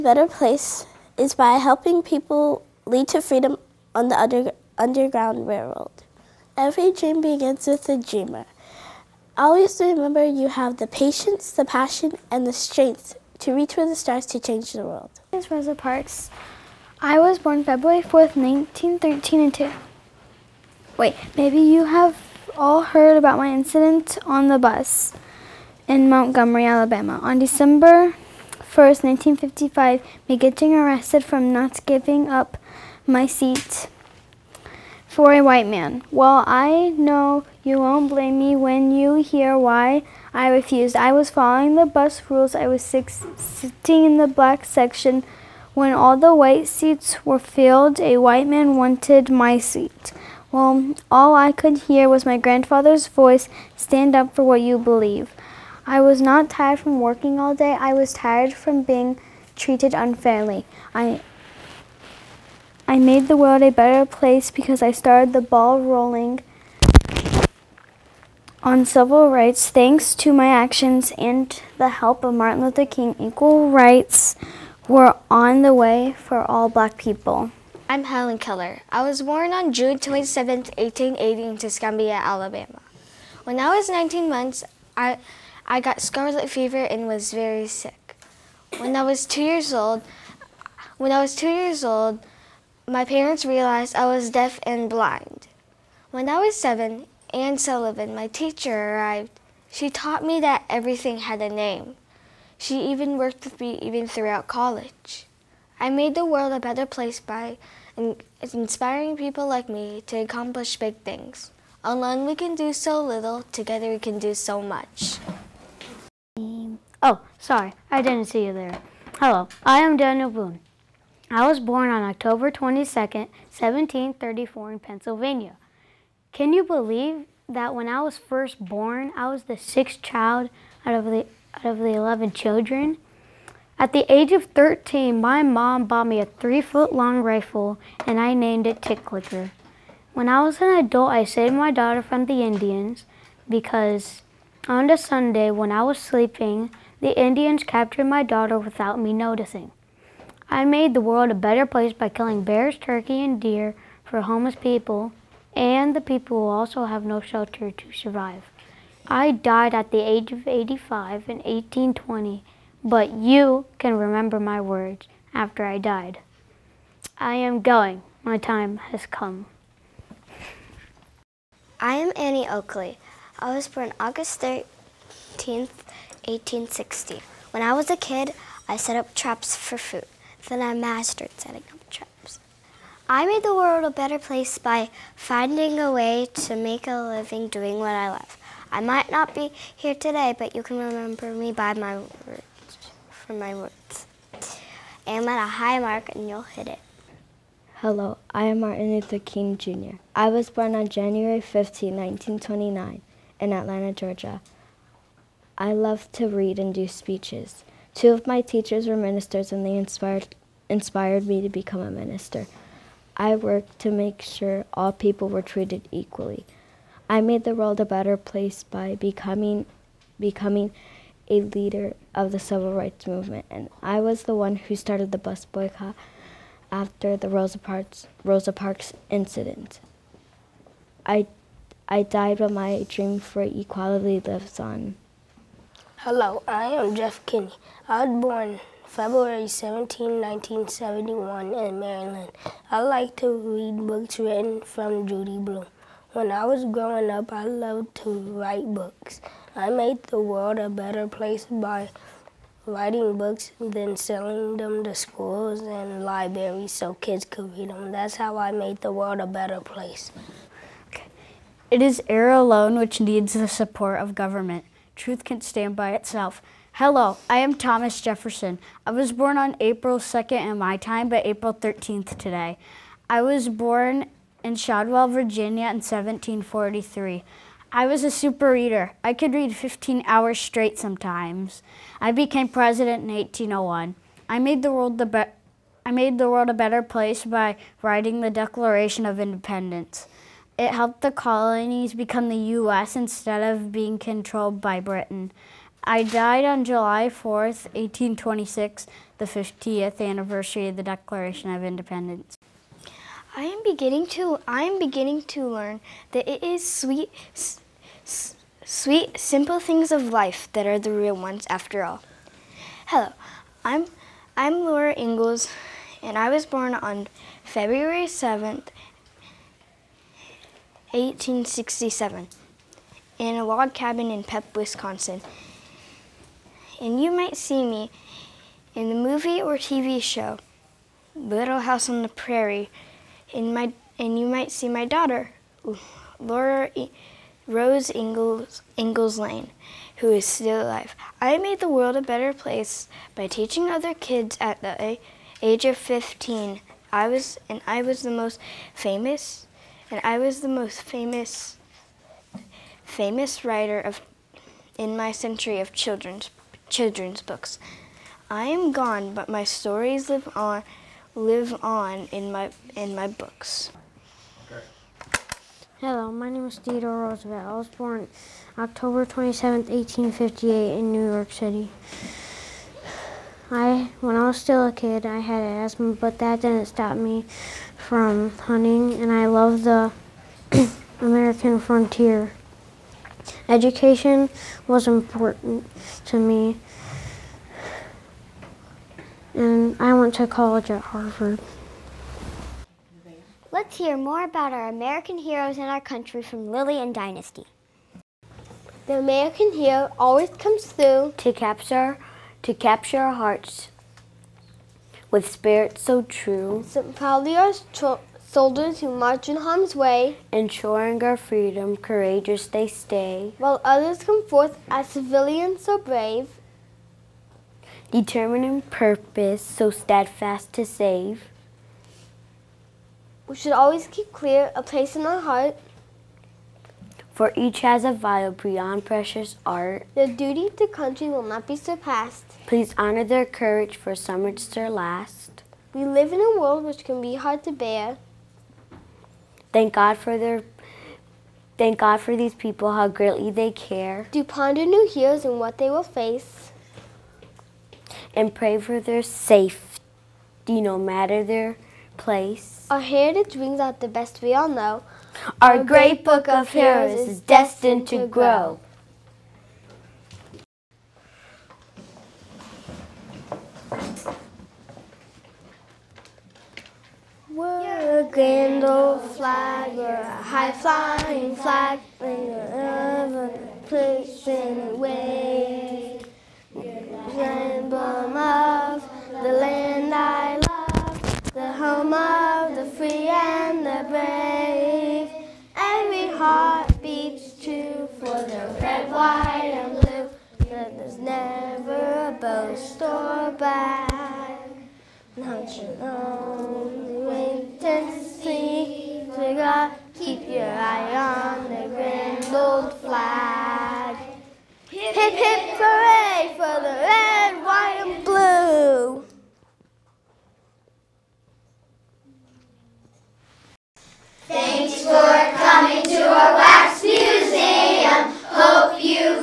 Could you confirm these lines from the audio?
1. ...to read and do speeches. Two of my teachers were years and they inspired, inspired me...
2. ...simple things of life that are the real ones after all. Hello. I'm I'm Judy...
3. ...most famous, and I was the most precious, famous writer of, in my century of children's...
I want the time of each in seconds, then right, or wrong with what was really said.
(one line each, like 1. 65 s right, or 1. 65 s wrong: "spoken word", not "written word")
1. 206 s wrong: "ministers", not "years"
2. 309 s wrong: "Laura", not "Judy"
3. 348 s wrong: "famous", not "precious".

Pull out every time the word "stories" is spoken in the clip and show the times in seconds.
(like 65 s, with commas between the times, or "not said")
359 s.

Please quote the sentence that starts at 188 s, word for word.
I might not be here today, but you can remember me by my words, from my words.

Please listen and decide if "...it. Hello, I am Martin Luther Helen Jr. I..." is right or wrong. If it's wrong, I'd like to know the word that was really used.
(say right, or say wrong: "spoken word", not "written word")
wrong: "King", not "Helen".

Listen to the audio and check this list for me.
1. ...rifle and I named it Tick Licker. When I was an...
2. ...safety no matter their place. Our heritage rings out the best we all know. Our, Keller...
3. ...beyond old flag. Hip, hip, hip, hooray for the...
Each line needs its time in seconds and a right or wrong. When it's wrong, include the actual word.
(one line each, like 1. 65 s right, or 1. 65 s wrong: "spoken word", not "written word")
1. 137 s right
2. 449 s wrong: "Our", not "Keller"
3. 501 s wrong: "grand", not "beyond".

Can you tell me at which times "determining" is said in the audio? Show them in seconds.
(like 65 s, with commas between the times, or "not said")
417 s.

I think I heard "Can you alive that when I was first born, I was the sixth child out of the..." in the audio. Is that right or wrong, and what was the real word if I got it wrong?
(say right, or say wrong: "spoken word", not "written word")
wrong: "believe", not "alive".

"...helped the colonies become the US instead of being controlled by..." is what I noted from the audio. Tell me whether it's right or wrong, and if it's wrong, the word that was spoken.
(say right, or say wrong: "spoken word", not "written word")
right.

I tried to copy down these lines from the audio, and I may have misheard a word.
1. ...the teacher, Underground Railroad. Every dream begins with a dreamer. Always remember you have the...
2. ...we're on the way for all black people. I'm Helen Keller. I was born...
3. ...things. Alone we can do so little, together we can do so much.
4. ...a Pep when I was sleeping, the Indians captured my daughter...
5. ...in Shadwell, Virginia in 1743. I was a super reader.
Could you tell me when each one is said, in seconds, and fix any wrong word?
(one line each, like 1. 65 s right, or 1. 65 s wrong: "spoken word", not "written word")
1. 4 s wrong: "under", not "teacher"
2. 74 s right
3. 110 s right
4. 144 s wrong: "Sunday", not "Pep"
5. 274 s right.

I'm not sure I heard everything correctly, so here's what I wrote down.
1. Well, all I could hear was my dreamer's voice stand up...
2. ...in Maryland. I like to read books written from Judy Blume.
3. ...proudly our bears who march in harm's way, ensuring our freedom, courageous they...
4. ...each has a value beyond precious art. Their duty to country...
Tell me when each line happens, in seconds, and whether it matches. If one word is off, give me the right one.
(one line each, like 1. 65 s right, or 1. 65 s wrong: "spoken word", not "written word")
1. 50 s wrong: "grandfather", not "dreamer"
2. 241 s right
3. 406 s wrong: "soldiers", not "bears"
4. 427 s right.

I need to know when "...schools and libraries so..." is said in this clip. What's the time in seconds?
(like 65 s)
254 s.